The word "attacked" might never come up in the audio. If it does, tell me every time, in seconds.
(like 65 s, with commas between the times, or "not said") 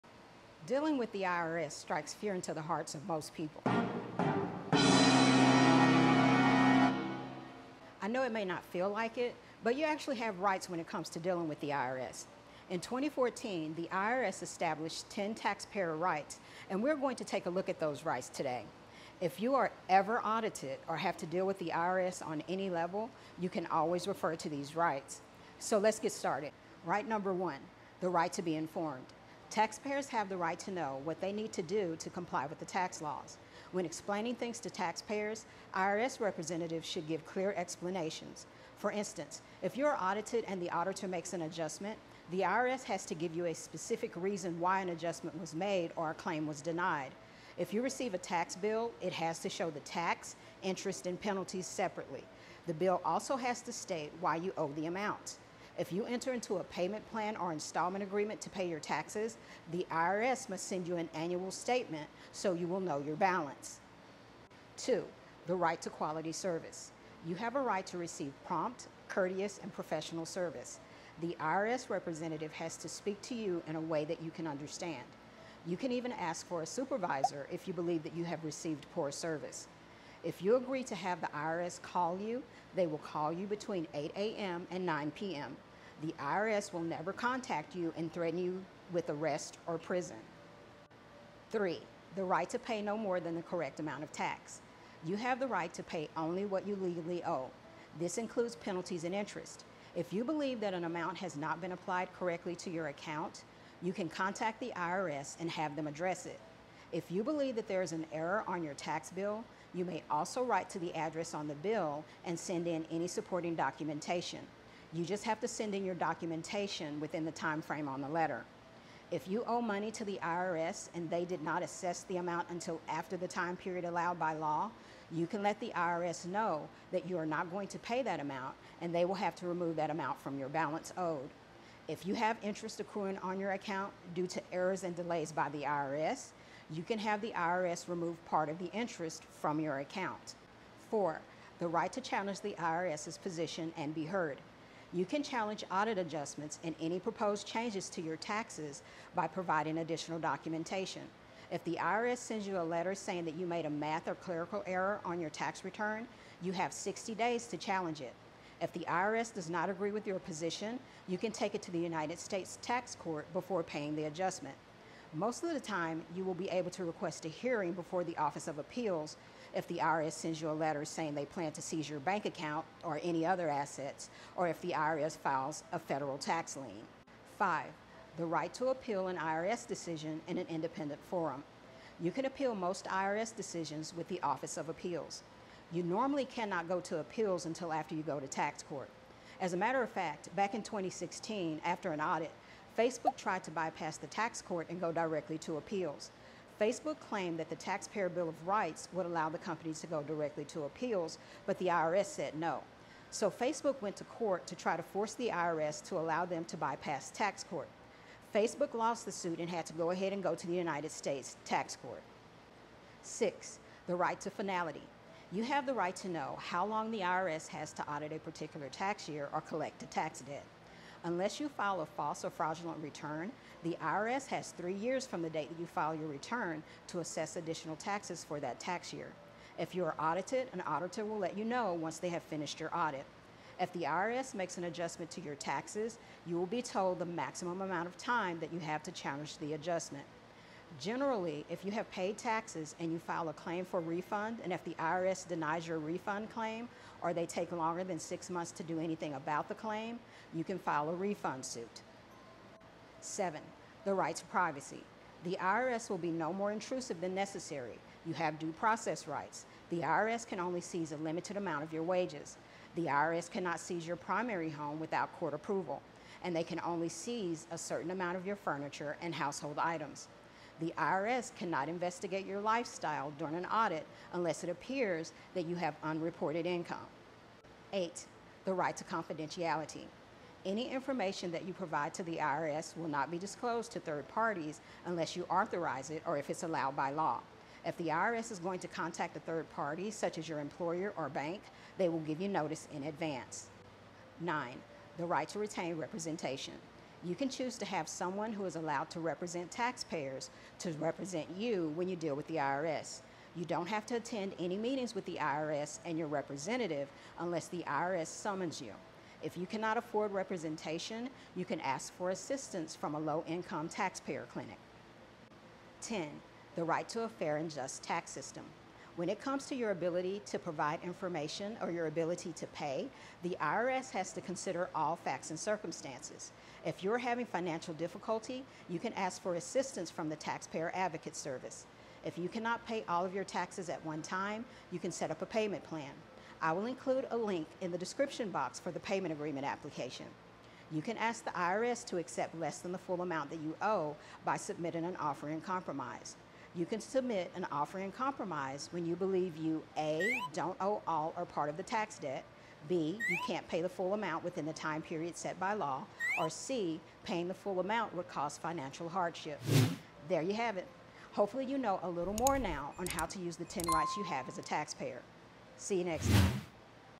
not said.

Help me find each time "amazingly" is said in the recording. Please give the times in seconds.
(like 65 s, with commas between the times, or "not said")
not said.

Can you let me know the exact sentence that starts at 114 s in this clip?
You just have to send in your documentation within the time frame on the letter.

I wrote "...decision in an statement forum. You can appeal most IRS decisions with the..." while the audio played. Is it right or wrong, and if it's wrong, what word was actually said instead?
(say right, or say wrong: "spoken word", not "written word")
wrong: "independent", not "statement".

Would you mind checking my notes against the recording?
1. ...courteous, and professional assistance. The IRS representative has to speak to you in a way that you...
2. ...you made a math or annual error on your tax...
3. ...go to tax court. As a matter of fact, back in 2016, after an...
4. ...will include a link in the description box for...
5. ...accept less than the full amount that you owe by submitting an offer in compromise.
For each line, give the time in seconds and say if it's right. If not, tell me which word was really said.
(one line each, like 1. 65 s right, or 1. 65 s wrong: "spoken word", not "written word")
1. 69 s wrong: "service", not "assistance"
2. 153 s wrong: "clerical", not "annual"
3. 188 s right
4. 336 s right
5. 341 s right.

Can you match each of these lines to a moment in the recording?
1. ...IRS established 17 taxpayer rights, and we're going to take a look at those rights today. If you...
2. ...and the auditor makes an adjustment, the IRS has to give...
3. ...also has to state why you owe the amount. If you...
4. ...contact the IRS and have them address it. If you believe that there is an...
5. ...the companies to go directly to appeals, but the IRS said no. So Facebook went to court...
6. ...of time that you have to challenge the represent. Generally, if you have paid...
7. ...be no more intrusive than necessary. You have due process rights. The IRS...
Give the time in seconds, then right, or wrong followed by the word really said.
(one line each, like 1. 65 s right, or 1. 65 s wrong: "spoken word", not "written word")
1. 13 s wrong: "10", not "17"
2. 40 s right
3. 53 s right
4. 104 s right
5. 199 s right
6. 237 s wrong: "adjustment", not "represent"
7. 255 s right.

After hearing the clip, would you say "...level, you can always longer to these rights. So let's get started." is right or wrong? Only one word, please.
wrong.